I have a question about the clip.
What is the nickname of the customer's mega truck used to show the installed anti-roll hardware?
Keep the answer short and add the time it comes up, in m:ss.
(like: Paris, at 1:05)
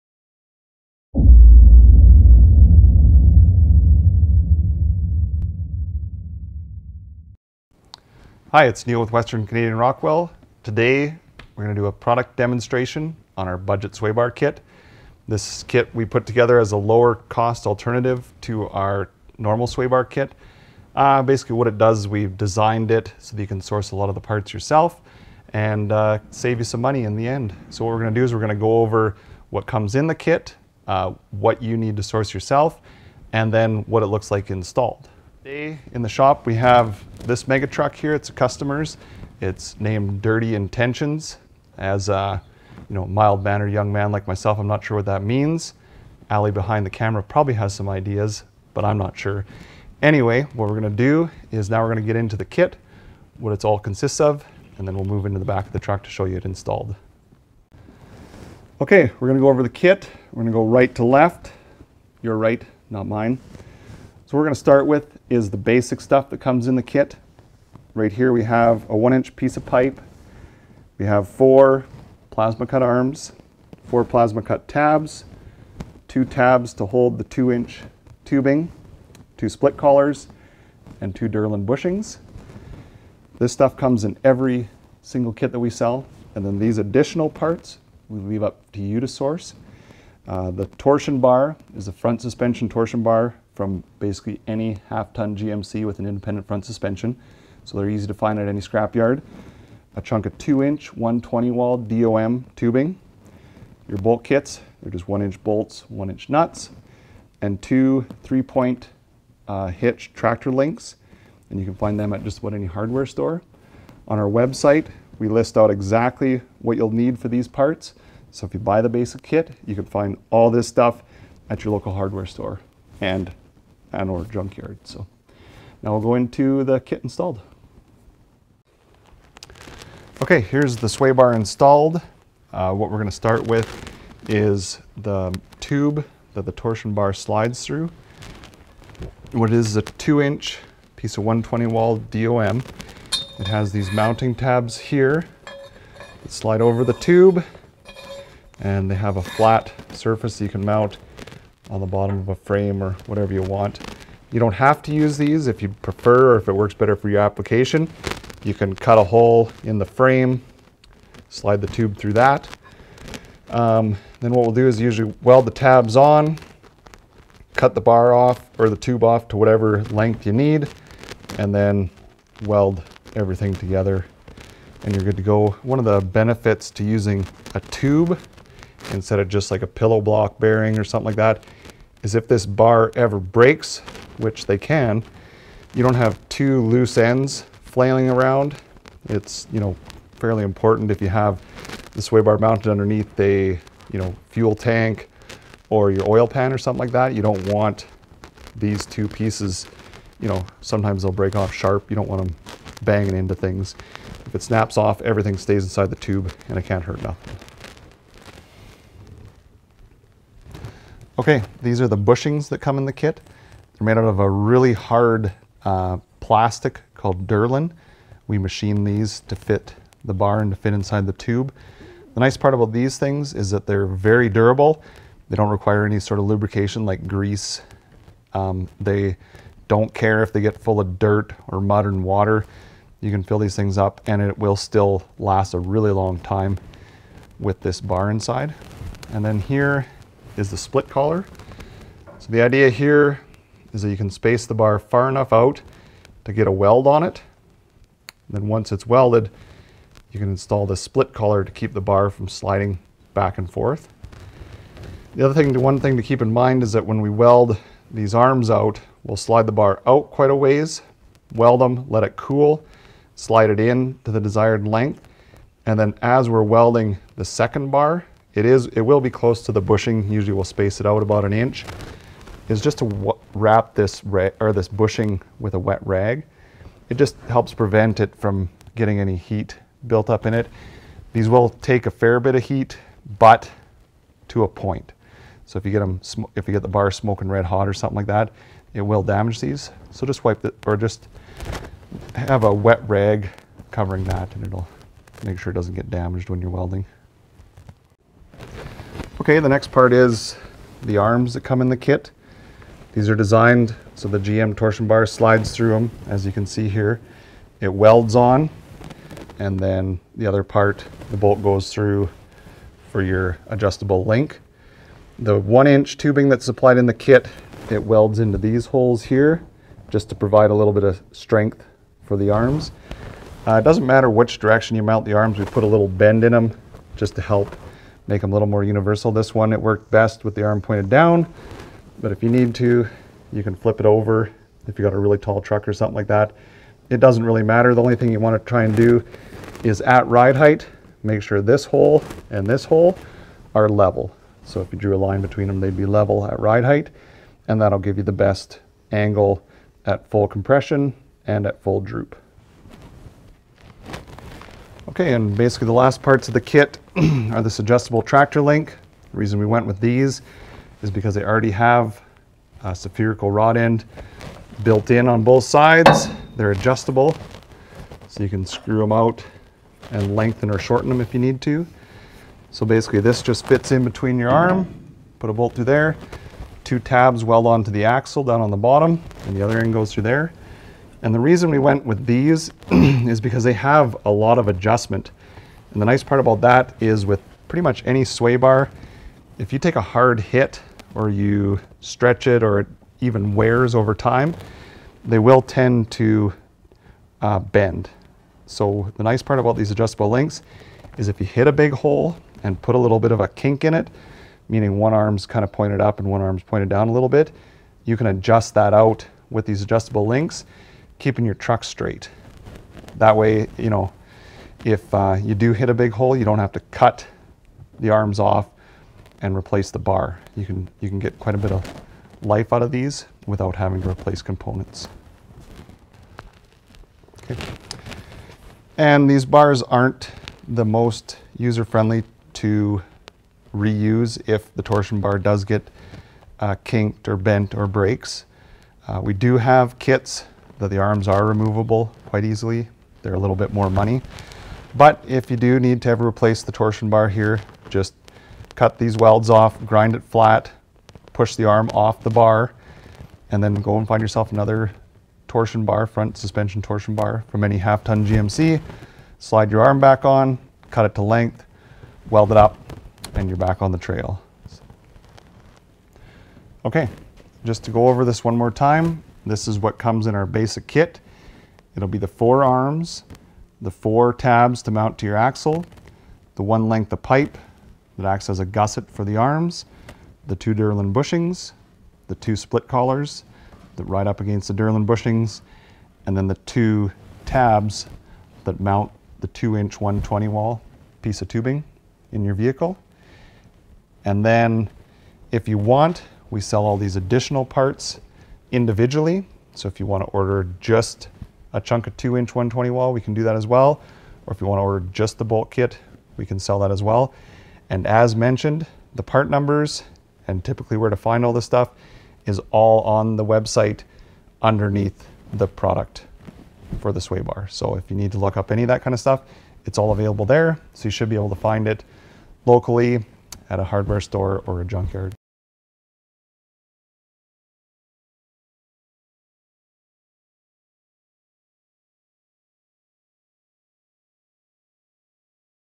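Dirty Intentions, at 0:40.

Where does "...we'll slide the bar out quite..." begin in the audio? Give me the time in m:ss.
4:19.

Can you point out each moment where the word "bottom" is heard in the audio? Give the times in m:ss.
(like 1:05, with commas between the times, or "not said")
2:31, 6:18.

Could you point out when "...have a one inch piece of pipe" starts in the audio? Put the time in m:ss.
1:08.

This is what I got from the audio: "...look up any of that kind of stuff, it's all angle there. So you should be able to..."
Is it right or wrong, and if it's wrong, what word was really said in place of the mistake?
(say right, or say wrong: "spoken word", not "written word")
wrong: "available", not "angle".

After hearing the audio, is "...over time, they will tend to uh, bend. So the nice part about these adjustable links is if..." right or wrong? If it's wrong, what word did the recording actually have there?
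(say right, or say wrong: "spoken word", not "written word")
right.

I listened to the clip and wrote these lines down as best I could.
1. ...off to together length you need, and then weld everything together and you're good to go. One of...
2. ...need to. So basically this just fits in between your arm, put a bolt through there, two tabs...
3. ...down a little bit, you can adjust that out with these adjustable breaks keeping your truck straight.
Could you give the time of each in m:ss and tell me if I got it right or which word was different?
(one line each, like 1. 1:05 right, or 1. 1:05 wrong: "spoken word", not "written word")
1. 2:49 wrong: "whatever", not "together"
2. 6:11 right
3. 6:46 wrong: "links", not "breaks".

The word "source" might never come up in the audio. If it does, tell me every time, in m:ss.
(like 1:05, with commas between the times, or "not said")
0:23, 0:32, 1:29.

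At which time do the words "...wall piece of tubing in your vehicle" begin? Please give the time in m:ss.
8:10.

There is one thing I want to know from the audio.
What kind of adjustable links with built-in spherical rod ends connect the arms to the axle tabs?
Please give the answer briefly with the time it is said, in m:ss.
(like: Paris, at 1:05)
3-point hitch tractor links, at 1:48.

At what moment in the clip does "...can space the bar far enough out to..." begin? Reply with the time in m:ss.
4:03.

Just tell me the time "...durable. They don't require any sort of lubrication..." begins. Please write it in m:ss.
3:44.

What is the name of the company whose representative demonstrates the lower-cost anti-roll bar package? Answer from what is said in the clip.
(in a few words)
Western Canadian Rockwell.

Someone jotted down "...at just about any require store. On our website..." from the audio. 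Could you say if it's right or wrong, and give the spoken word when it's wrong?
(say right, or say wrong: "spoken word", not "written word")
wrong: "hardware", not "require".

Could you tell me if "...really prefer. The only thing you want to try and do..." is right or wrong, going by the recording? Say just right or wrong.
wrong.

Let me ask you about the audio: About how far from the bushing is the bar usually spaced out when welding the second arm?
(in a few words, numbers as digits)
1 inch.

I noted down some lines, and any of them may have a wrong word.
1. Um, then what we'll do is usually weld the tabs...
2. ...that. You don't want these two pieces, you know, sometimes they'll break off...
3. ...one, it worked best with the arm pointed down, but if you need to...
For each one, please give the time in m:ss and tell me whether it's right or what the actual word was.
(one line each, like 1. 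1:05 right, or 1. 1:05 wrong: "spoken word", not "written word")
1. 2:43 right
2. 3:16 right
3. 5:29 right.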